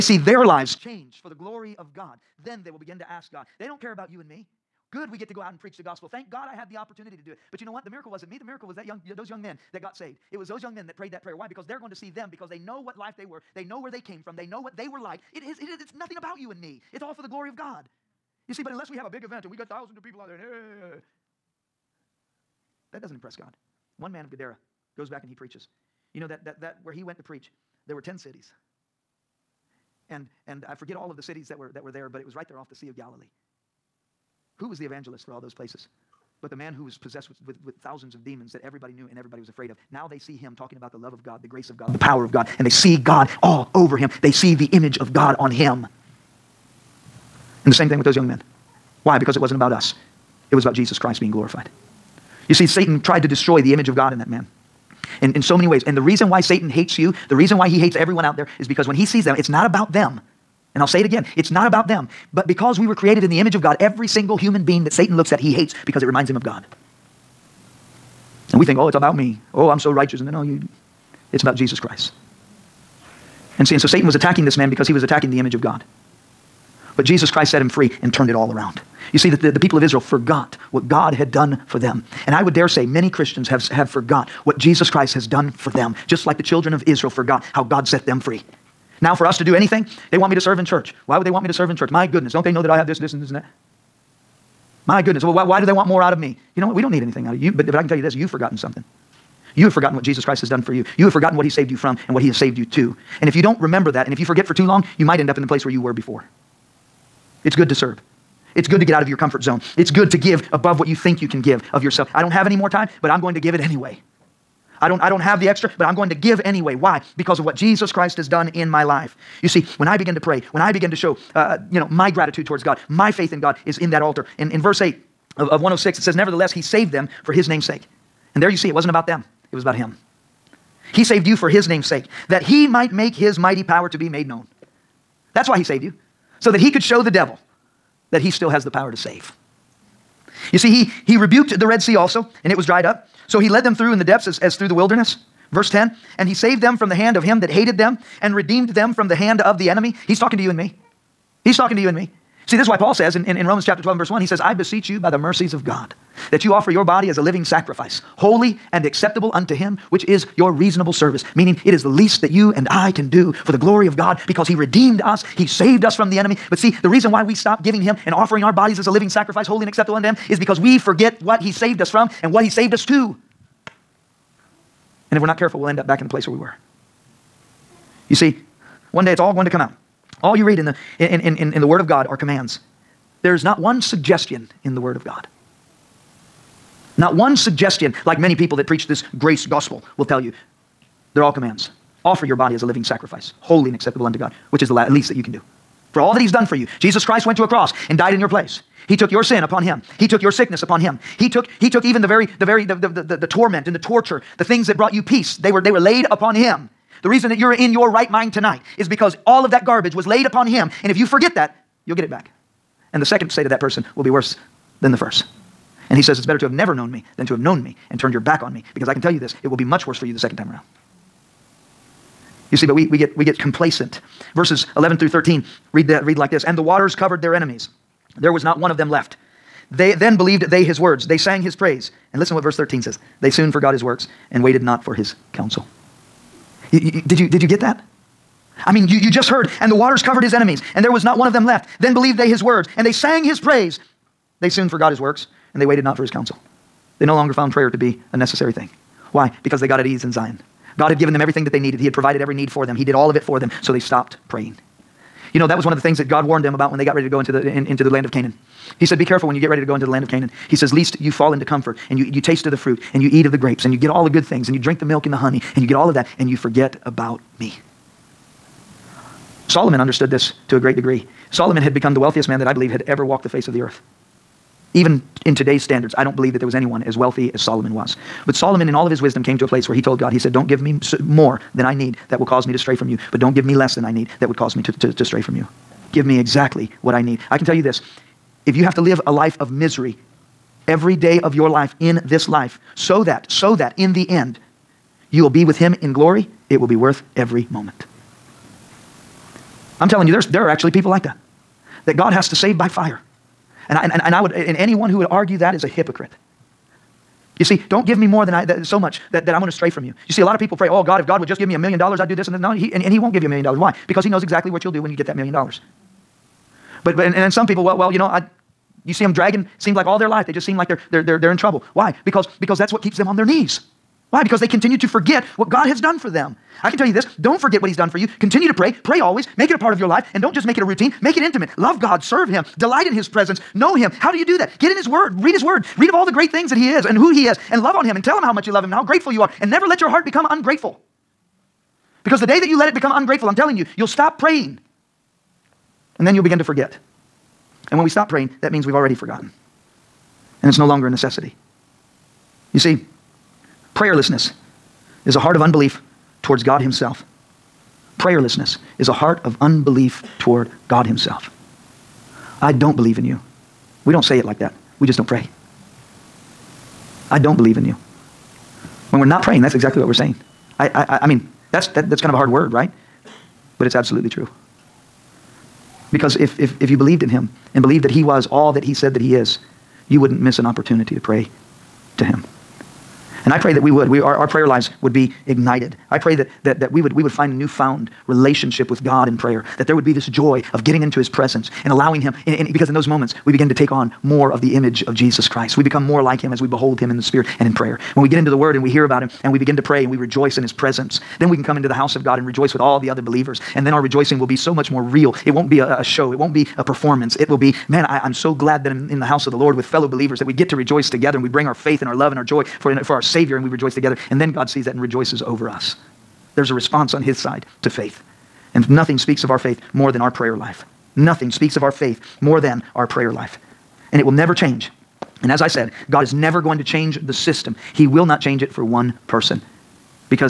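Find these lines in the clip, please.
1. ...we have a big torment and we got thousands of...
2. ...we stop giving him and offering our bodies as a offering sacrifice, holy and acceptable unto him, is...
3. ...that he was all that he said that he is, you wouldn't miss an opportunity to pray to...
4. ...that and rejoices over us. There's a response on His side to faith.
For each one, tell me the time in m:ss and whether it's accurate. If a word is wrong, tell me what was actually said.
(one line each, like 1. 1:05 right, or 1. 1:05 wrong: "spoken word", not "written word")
1. 0:18 wrong: "event", not "torment"
2. 2:47 wrong: "living", not "offering"
3. 6:17 right
4. 6:54 right.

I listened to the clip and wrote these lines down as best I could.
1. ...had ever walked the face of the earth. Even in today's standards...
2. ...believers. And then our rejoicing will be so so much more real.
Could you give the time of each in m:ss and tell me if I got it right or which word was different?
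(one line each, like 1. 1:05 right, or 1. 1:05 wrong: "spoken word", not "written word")
1. 4:32 right
2. 6:43 right.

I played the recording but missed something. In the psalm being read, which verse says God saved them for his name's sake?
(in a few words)
Verse 8.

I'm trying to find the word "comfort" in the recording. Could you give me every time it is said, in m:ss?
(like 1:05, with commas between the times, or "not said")
1:49, 4:21.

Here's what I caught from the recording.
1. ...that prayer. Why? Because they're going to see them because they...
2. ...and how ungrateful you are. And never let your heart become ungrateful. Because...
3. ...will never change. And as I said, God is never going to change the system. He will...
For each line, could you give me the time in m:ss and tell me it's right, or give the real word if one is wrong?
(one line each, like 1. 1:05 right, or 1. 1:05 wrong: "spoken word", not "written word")
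1. 0:11 right
2. 5:38 wrong: "grateful", not "ungrateful"
3. 7:04 right.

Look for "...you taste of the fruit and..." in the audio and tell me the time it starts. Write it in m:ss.
4:22.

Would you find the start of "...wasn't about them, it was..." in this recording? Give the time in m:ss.
2:08.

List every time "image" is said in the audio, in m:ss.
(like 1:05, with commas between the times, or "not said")
0:44, 0:53, 1:03, 1:15, 6:34.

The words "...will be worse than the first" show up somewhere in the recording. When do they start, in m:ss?
3:33.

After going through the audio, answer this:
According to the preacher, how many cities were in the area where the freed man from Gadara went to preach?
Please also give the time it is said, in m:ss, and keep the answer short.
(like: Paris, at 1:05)
10, at 0:28.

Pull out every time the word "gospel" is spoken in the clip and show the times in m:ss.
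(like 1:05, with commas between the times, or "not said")
0:05, 3:09.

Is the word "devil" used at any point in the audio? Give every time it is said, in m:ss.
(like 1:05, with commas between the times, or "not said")
2:17.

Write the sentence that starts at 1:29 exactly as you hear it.
Now, for us to do anything, they want me to serve in church.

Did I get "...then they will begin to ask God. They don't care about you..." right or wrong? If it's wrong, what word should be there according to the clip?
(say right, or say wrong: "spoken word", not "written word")
right.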